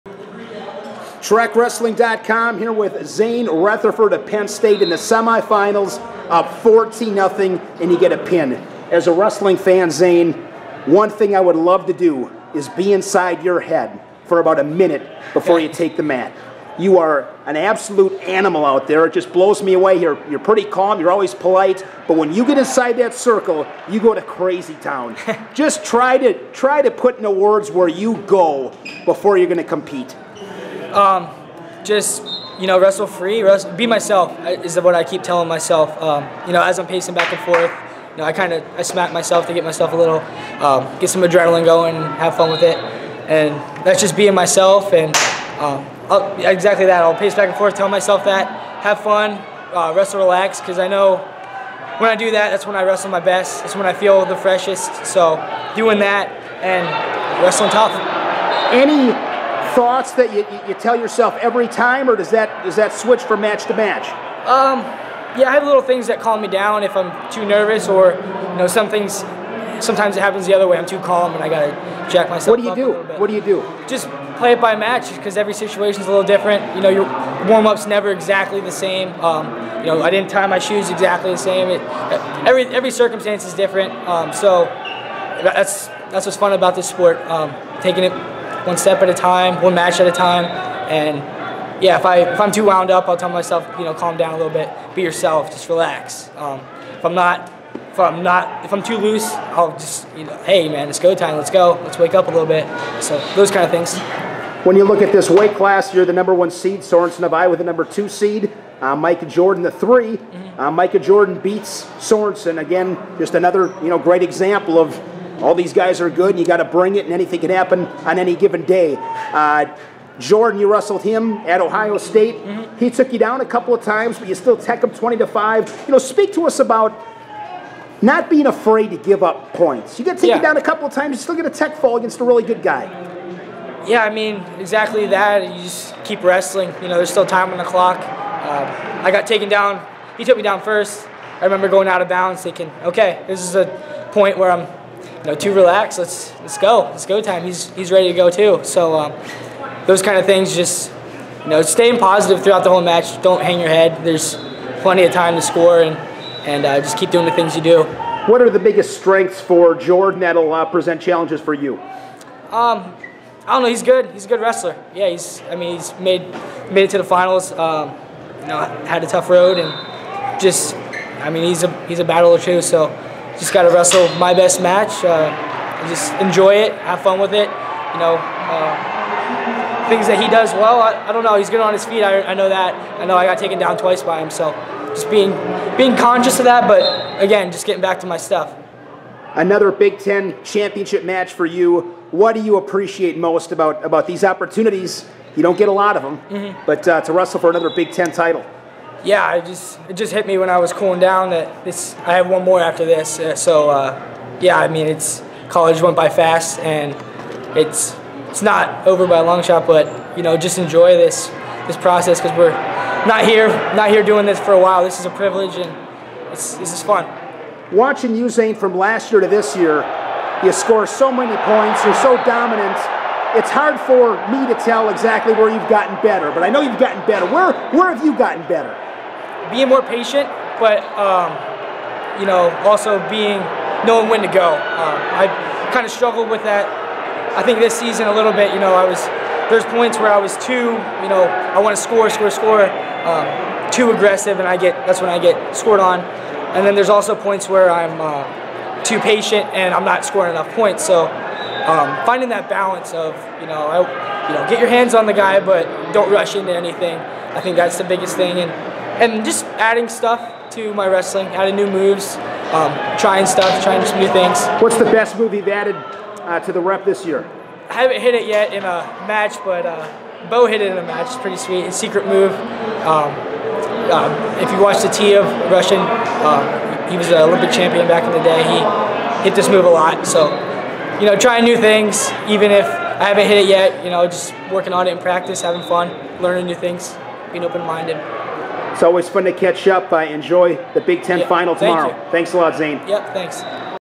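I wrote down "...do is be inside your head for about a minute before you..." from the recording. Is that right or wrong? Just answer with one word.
right.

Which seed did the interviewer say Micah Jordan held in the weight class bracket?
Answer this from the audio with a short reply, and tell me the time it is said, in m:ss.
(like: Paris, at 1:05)
3, at 1:49.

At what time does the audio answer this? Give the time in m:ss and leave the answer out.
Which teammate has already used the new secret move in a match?
4:30.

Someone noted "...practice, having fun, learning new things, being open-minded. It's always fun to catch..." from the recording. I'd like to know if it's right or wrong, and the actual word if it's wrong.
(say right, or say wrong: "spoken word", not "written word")
right.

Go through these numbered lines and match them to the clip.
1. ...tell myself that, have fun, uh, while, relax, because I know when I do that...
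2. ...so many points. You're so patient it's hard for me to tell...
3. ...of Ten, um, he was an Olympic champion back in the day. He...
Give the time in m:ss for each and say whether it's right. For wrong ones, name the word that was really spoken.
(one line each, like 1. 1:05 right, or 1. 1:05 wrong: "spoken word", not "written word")
1. 0:47 wrong: "wrestle", not "while"
2. 3:40 wrong: "dominant", not "patient"
3. 4:35 wrong: "Russian", not "Ten".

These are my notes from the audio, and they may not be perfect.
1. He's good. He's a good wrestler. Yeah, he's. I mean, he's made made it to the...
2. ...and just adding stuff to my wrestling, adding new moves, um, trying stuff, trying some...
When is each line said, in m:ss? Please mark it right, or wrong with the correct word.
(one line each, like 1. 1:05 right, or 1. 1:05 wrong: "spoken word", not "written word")
1. 2:43 right
2. 4:18 right.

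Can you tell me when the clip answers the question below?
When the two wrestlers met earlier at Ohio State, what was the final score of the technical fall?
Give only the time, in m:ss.
2:04.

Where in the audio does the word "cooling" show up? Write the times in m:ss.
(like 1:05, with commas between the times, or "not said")
3:20.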